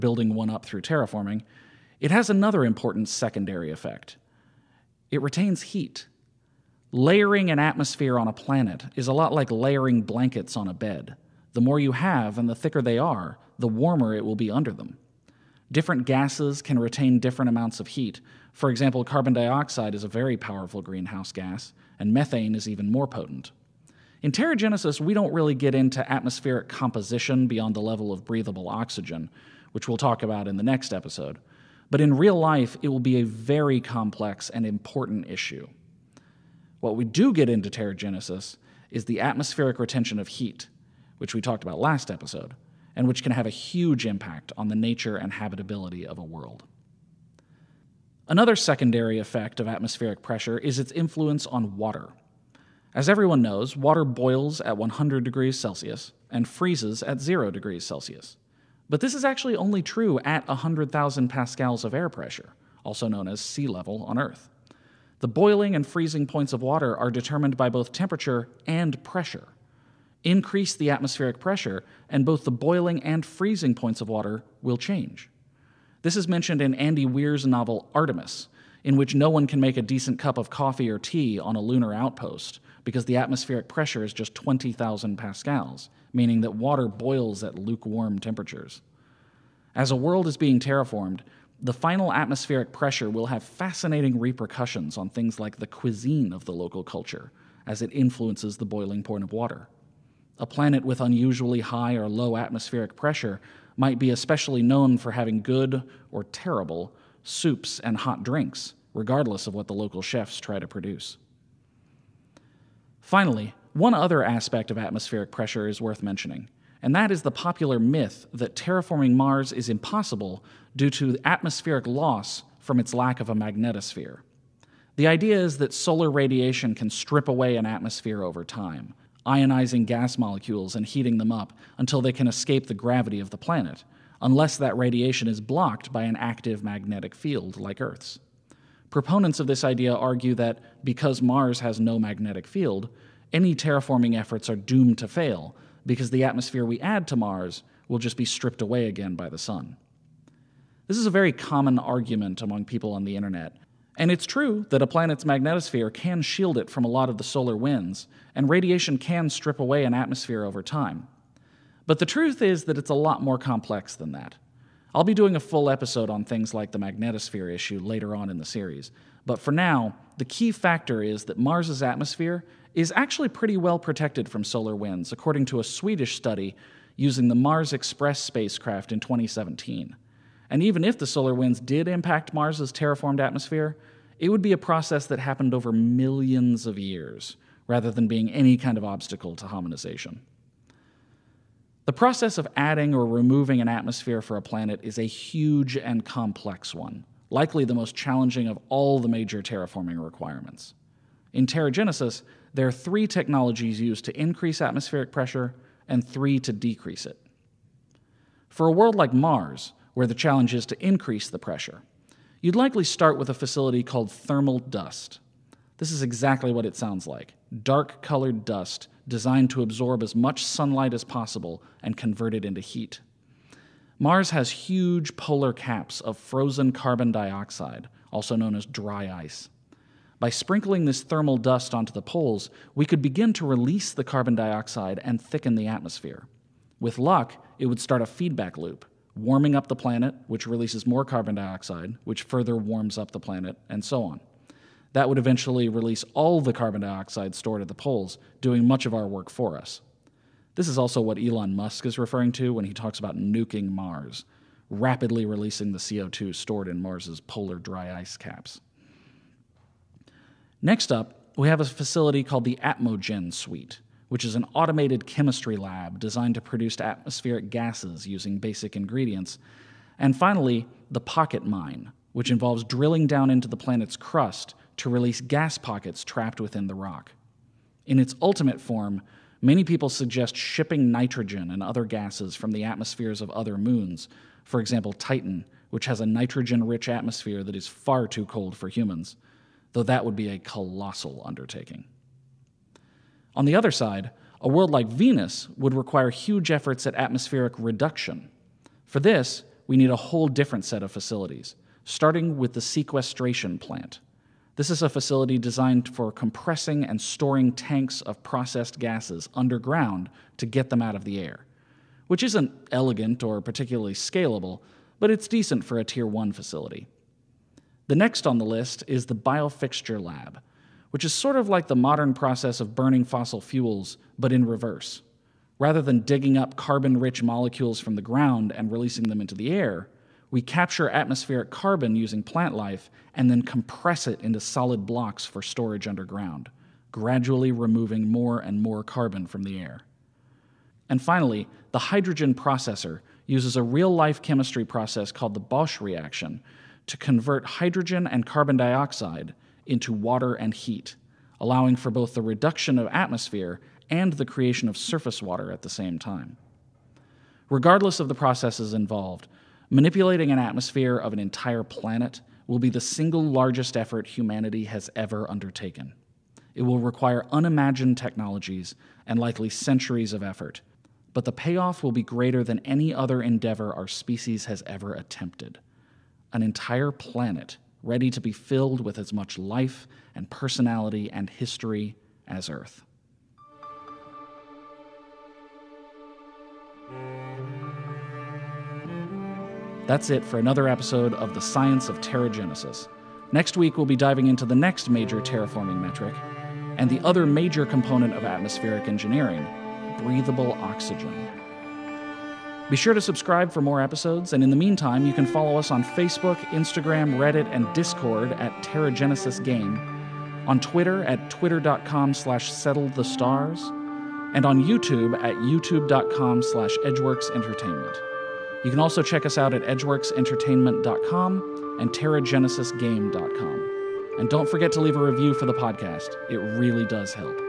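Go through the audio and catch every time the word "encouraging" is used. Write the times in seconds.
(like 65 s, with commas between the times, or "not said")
not said.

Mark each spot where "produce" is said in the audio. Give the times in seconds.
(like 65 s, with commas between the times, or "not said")
110 s, 266 s.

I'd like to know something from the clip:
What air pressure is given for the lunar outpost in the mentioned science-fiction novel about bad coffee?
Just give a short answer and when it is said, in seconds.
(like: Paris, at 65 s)
20,000 pascals, at 84 s.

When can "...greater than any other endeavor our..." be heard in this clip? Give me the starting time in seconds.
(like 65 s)
372 s.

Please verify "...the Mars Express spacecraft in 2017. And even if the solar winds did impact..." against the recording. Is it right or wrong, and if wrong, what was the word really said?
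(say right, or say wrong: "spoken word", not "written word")
right.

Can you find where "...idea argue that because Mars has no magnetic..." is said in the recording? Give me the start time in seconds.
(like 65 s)
139 s.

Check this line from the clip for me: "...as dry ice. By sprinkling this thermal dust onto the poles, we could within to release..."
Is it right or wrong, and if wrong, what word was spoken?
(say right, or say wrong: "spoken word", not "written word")
wrong: "begin", not "within".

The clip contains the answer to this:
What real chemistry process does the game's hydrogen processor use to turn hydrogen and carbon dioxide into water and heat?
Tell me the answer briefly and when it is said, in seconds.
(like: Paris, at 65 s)
Bosch reaction, at 345 s.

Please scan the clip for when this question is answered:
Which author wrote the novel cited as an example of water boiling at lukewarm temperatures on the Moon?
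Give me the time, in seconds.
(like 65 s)
76 s.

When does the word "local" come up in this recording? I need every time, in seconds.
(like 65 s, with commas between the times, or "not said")
96 s, 109 s.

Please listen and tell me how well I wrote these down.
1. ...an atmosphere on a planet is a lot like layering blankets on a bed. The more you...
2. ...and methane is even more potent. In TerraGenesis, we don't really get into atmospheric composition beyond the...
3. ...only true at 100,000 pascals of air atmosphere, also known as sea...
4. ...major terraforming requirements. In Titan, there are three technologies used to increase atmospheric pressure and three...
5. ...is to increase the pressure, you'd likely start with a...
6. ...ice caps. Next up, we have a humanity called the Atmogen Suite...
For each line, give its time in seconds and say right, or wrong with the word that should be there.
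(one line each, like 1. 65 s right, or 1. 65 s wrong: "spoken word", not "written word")
1. 7 s right
2. 21 s right
3. 59 s wrong: "pressure", not "atmosphere"
4. 199 s wrong: "TerraGenesis", not "Titan"
5. 210 s right
6. 257 s wrong: "facility", not "humanity".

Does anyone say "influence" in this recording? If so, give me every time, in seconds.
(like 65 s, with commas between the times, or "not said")
50 s, 97 s.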